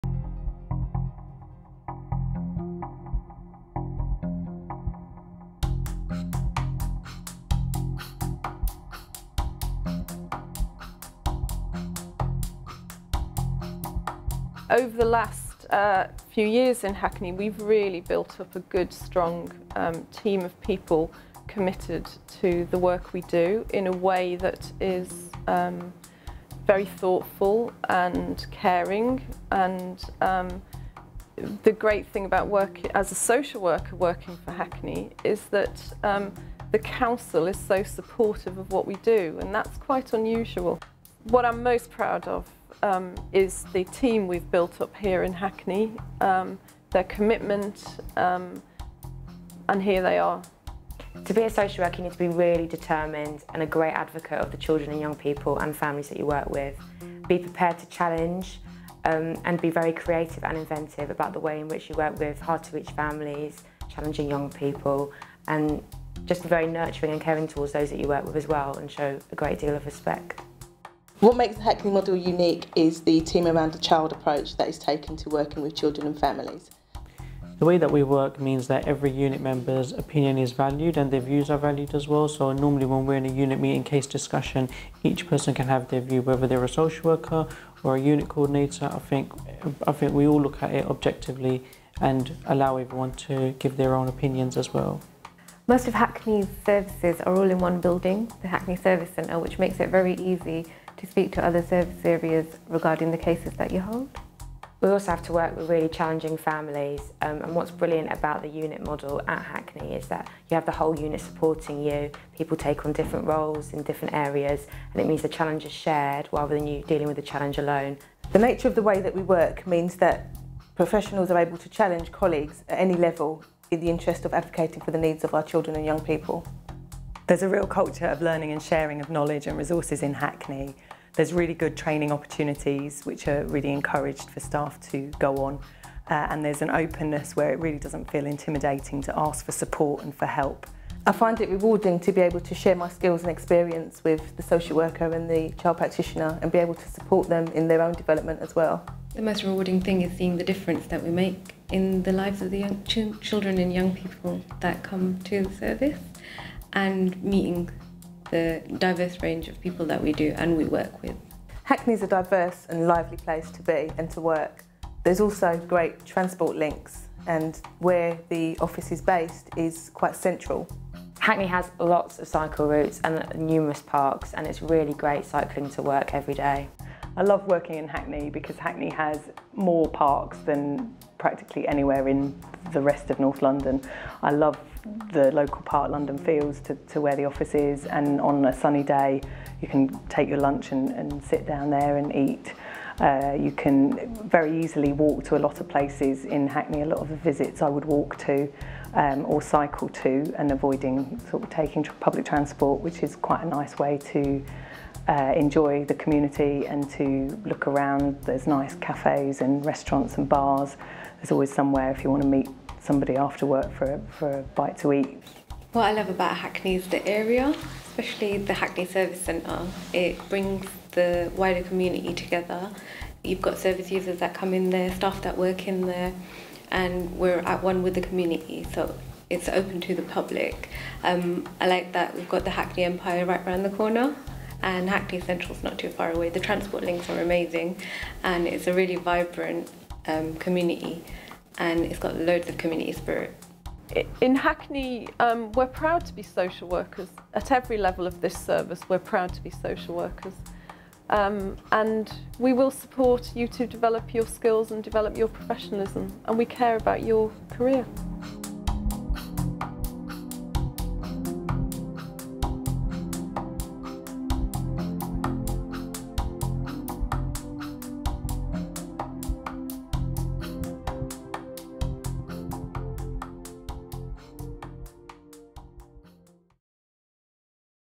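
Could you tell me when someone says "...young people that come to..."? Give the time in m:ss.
2:33.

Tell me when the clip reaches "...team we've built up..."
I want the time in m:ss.
0:43.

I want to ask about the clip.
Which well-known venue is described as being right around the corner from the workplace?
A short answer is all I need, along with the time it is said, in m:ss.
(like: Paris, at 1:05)
Hackney Empire, at 3:52.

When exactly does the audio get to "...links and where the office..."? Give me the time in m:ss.
2:46.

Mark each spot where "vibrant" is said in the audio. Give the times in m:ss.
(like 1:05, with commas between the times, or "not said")
3:58.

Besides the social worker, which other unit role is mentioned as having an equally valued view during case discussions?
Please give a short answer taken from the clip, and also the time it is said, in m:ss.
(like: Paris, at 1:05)
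unit coordinator, at 1:28.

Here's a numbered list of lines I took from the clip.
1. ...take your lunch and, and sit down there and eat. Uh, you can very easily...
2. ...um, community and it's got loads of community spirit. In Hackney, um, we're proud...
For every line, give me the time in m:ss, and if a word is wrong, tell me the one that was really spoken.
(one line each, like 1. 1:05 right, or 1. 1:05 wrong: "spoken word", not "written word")
1. 3:10 right
2. 4:00 right.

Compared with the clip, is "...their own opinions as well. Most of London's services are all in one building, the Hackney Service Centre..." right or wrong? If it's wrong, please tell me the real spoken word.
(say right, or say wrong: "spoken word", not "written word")
wrong: "Hackney", not "London".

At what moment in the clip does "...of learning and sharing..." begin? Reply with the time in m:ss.
2:08.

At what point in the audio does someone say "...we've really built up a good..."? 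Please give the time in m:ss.
0:17.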